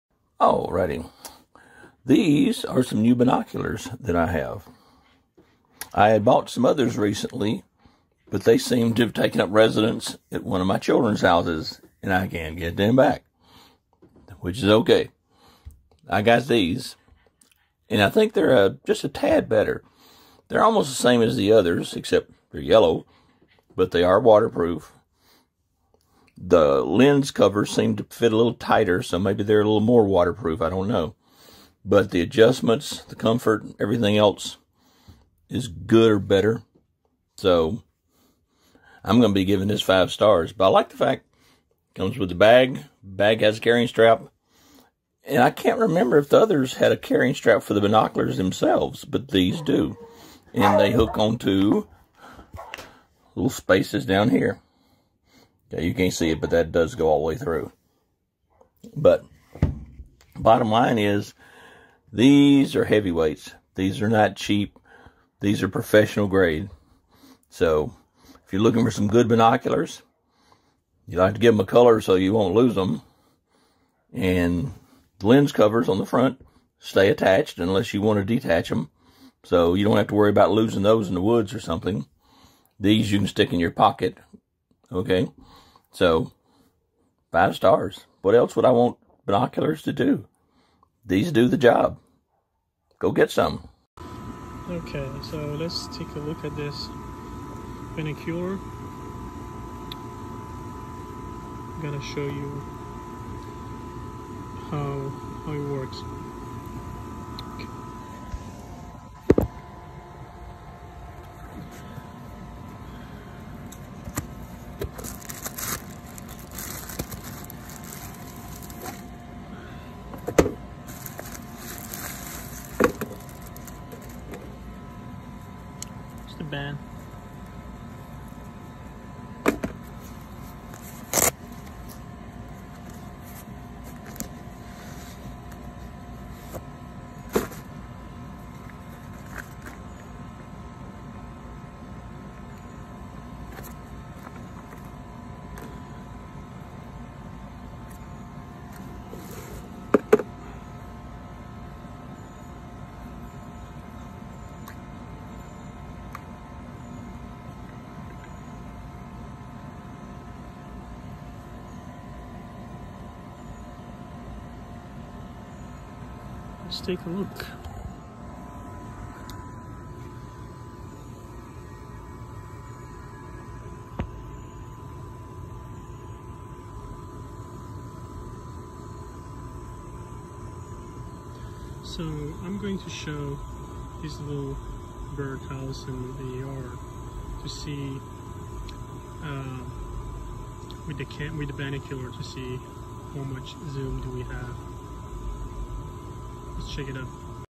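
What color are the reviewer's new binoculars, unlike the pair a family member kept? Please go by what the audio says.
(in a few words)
Yellow.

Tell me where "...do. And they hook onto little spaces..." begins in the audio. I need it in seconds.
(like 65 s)
49 s.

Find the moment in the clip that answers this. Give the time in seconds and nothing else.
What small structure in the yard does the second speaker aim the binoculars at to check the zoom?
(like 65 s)
185 s.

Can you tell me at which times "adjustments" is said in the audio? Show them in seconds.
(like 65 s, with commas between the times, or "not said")
32 s.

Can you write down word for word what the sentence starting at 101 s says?
I'm gonna show you how, how it works.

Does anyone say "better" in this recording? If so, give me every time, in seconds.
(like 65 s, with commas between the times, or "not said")
19 s, 36 s.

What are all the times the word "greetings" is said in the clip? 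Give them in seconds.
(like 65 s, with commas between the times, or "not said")
not said.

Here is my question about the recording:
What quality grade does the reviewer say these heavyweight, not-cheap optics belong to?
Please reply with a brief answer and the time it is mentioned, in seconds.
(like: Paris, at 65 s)
Professional grade, at 65 s.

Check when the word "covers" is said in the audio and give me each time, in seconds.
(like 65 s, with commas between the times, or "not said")
27 s, 75 s.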